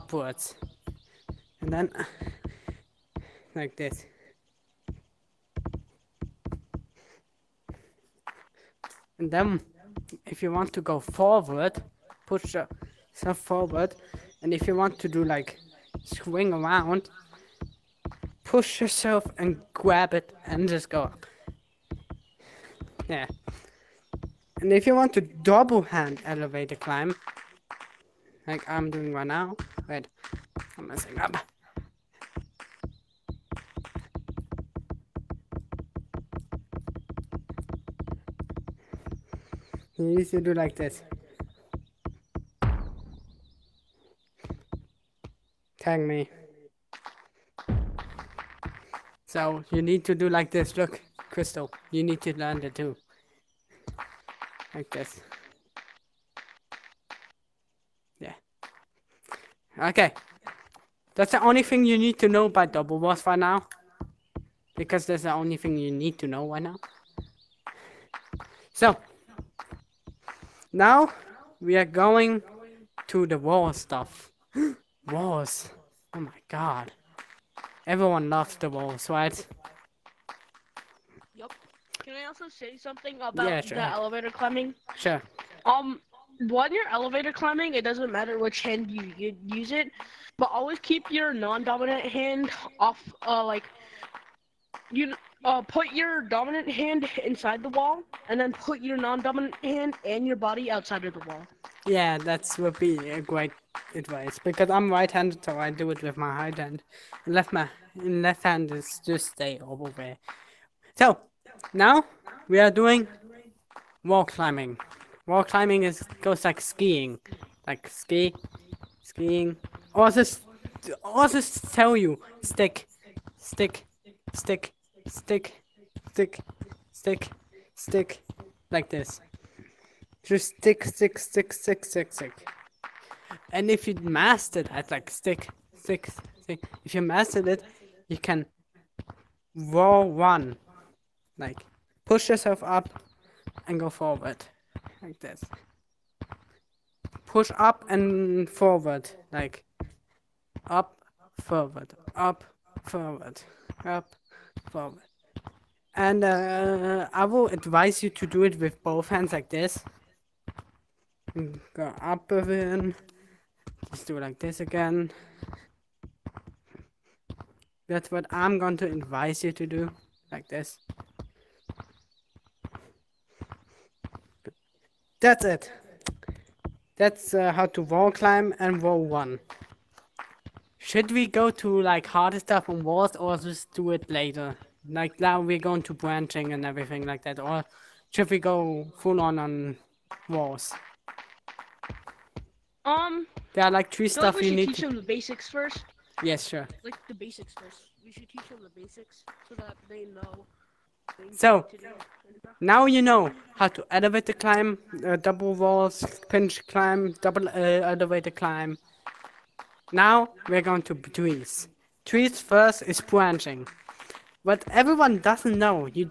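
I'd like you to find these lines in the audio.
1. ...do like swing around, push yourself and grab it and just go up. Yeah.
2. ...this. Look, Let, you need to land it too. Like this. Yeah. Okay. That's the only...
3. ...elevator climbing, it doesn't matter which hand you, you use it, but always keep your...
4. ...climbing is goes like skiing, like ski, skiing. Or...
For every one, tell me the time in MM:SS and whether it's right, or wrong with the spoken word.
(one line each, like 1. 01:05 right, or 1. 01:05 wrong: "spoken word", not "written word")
1. 00:15 right
2. 00:50 wrong: "Crystal", not "Let"
3. 01:26 right
4. 01:55 right.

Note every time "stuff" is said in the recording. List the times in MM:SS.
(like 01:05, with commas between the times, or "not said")
01:13, 03:02, 03:14.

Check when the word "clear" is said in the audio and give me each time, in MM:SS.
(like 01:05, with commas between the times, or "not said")
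not said.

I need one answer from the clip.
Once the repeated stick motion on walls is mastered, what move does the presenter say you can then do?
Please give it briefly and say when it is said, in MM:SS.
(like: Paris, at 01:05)
roll one, at 02:19.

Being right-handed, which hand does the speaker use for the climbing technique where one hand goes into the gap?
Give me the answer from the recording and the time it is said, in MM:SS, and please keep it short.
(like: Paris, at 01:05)
right hand, at 01:46.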